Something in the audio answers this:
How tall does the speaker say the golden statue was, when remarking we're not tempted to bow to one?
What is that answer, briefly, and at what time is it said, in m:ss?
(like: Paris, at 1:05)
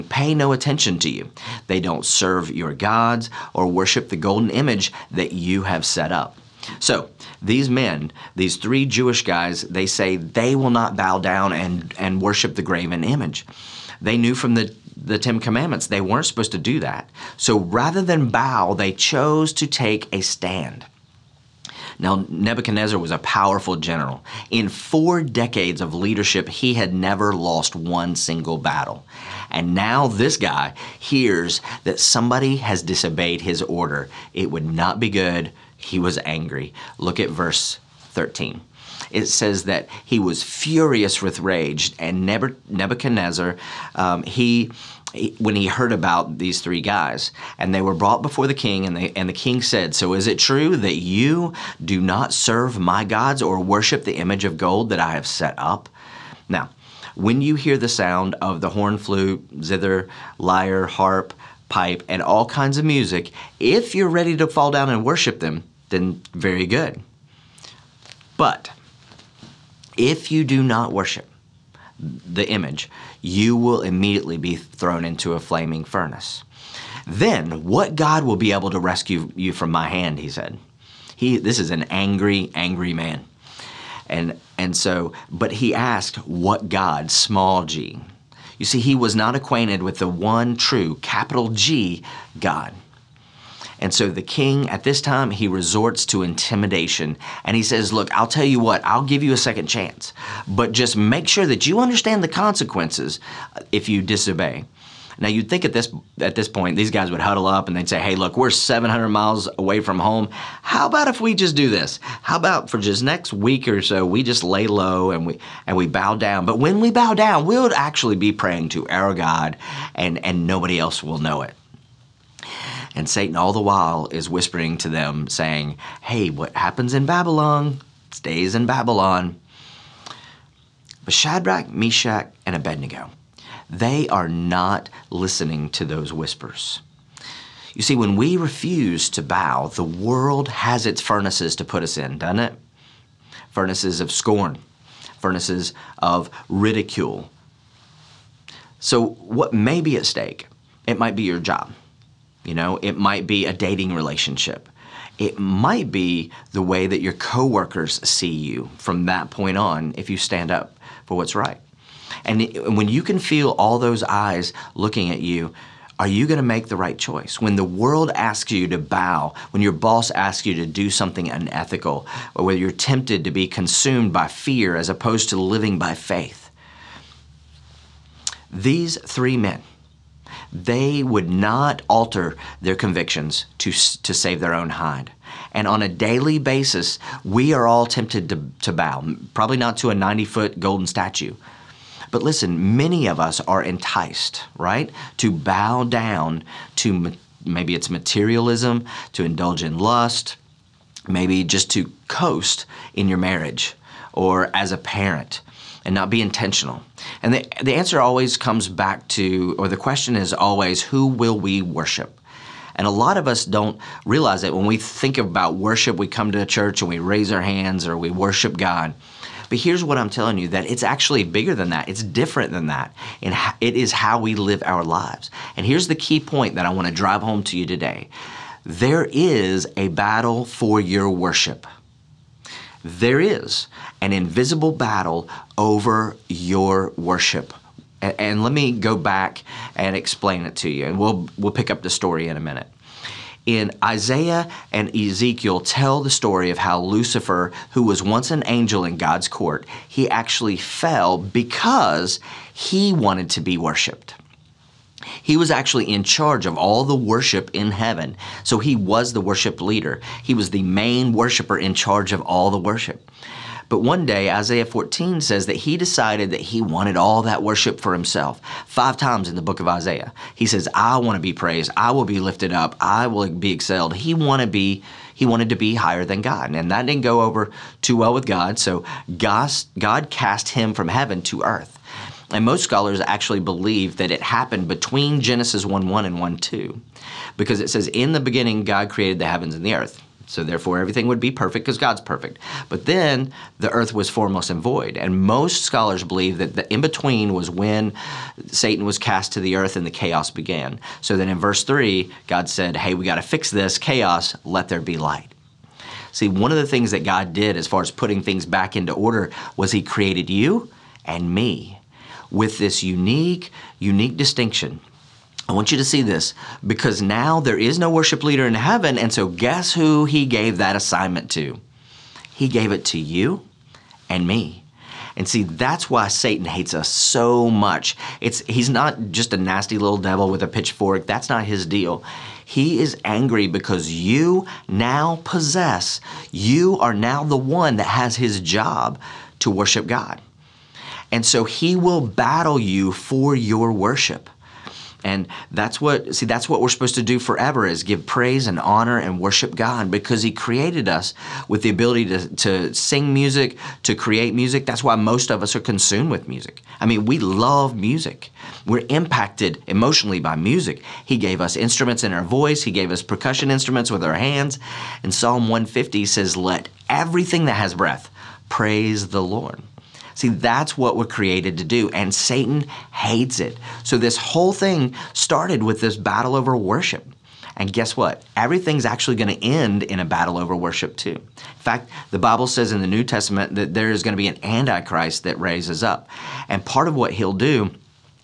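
90 foot, at 3:09.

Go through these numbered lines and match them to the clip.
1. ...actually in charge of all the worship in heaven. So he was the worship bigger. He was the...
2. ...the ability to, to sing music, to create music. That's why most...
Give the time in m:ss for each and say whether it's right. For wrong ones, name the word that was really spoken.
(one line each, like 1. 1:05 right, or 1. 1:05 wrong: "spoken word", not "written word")
1. 4:15 wrong: "leader", not "bigger"
2. 5:51 right.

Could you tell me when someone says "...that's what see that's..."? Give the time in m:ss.
5:45.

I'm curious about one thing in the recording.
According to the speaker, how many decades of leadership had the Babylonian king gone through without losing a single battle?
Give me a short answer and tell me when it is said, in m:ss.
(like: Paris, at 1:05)
4, at 0:24.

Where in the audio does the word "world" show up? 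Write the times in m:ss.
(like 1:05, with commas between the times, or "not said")
2:19, 2:47.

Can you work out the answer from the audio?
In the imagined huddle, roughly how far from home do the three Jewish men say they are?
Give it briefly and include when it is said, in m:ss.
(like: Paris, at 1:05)
700 miles, at 1:48.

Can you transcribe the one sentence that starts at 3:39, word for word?
But here's what I'm telling you that it's actually bigger than that.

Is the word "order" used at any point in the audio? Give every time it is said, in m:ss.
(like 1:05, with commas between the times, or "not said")
0:33, 5:08.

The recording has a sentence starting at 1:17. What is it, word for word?
Then what God will be able to rescue you from my hand, he said.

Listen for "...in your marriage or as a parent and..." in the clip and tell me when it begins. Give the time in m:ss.
3:22.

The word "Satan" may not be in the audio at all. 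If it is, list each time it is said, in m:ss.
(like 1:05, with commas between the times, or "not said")
2:03, 4:58, 5:26, 6:12.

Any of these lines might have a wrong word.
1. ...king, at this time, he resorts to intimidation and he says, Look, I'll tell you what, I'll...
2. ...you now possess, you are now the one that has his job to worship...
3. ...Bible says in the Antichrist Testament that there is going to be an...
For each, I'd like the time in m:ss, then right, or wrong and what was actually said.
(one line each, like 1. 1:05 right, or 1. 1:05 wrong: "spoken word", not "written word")
1. 1:34 right
2. 5:33 right
3. 6:22 wrong: "New", not "Antichrist".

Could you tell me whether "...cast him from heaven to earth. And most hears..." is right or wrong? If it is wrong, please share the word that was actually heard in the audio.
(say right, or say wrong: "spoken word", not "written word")
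wrong: "scholars", not "hears".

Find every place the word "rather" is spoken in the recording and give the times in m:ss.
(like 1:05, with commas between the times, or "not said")
0:17.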